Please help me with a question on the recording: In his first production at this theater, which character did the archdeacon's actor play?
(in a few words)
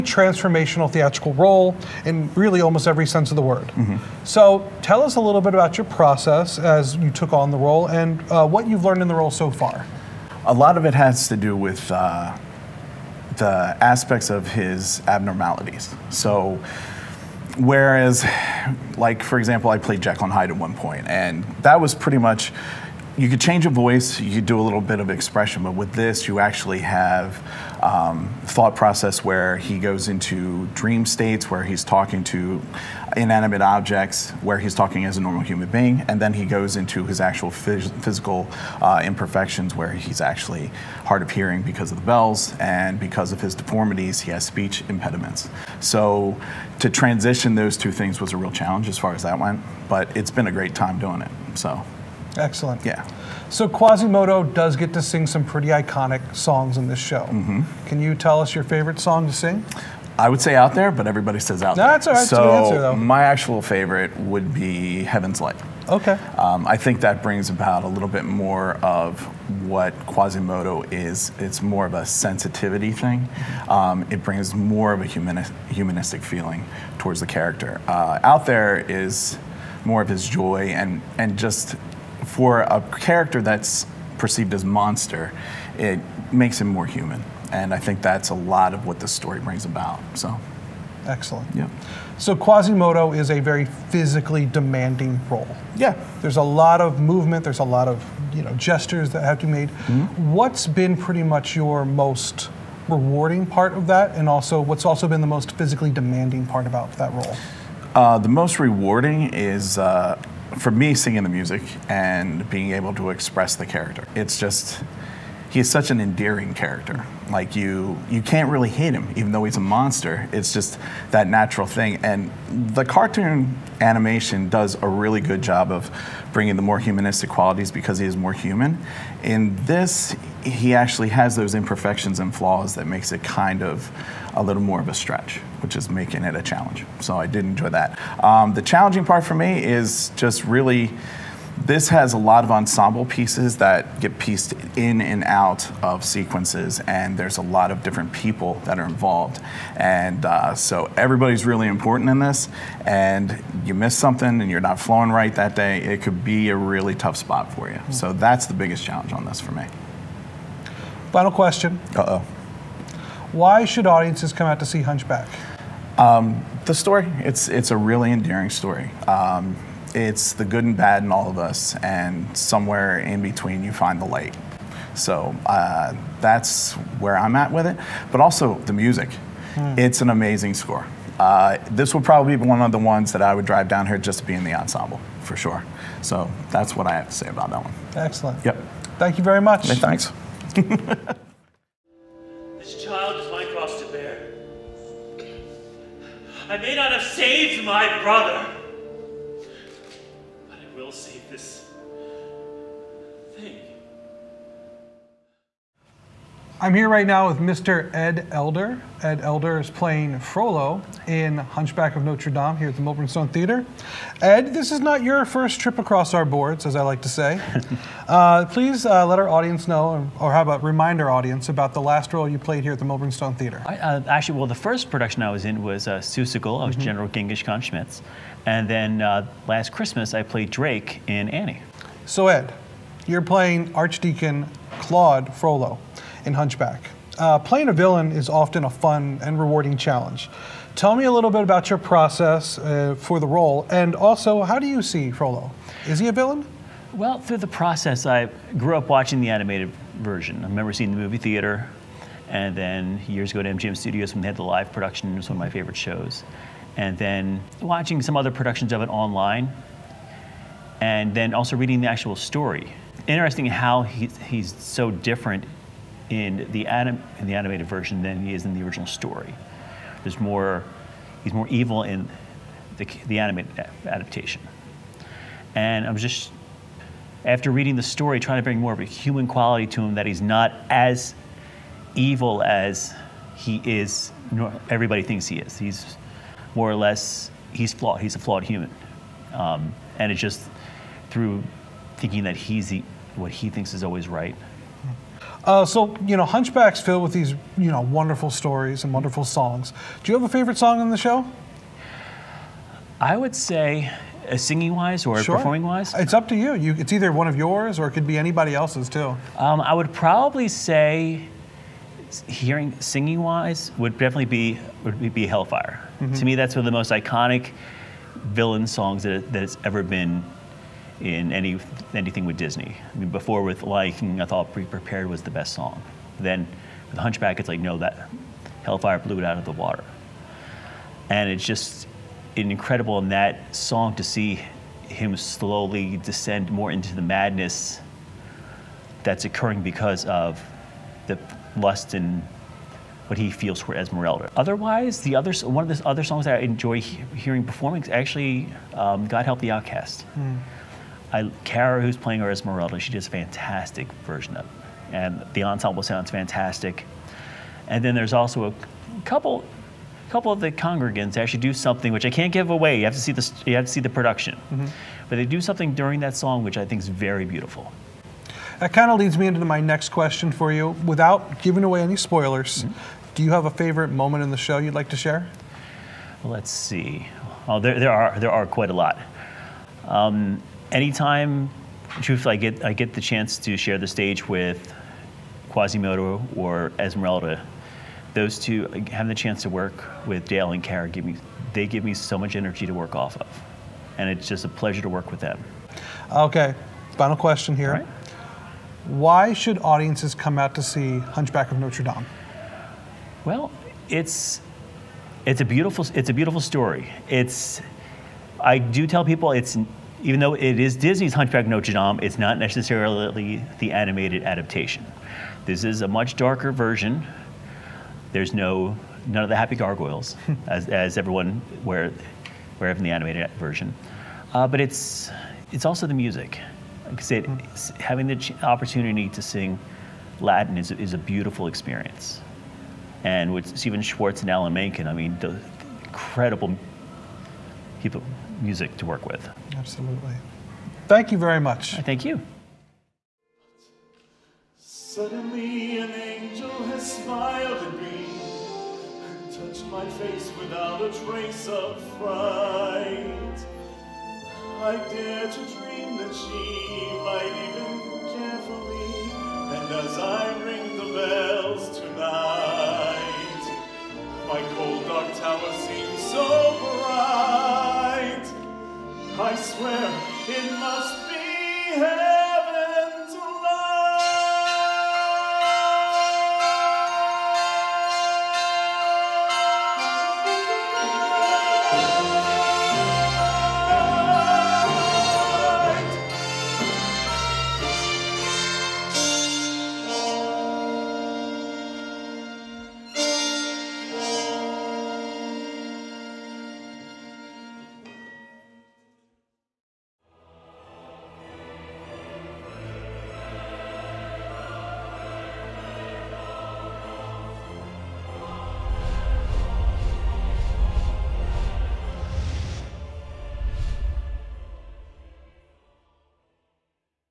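General Genghis Khan Schmitz.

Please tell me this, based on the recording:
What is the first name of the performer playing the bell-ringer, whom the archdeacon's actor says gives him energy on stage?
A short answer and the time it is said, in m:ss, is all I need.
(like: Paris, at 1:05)
Dale, at 6:30.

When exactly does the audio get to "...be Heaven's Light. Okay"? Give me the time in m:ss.
1:04.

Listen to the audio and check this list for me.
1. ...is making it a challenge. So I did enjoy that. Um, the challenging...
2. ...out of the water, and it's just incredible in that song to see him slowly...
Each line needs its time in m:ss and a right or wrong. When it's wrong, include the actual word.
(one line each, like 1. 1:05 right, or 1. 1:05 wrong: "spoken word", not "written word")
1. 2:15 right
2. 5:29 right.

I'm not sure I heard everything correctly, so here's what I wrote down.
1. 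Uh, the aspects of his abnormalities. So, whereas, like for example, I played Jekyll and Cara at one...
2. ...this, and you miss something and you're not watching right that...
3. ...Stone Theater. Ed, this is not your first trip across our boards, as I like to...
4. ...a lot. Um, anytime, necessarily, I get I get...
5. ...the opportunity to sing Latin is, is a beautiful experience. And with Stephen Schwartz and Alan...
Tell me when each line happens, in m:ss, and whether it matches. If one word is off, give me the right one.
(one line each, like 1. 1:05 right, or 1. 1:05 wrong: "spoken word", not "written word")
1. 0:11 wrong: "Hyde", not "Cara"
2. 2:32 wrong: "flowing", not "watching"
3. 3:33 right
4. 6:18 wrong: "truthfully", not "necessarily"
5. 7:08 right.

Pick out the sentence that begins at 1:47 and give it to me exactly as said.
Uh, the most rewarding is uh, for me, singing the music and being able to express the character.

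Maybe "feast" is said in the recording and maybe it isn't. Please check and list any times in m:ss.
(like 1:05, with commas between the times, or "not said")
not said.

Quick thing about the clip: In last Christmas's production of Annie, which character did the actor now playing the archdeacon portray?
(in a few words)
Drake.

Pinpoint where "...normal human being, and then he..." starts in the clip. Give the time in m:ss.
0:35.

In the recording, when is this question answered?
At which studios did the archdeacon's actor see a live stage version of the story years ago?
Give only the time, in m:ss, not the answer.
4:13.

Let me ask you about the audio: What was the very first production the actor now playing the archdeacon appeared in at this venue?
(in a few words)
Seussical.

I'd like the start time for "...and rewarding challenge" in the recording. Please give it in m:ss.
3:59.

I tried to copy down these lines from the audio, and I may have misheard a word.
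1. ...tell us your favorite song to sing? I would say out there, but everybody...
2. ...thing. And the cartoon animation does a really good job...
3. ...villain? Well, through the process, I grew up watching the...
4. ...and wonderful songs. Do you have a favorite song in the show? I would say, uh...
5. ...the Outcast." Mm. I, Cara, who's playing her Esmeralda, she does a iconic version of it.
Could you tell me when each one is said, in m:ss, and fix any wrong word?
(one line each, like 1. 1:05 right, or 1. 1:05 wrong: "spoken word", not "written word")
1. 0:58 right
2. 2:01 right
3. 4:06 right
4. 4:58 right
5. 5:49 wrong: "fantastic", not "iconic".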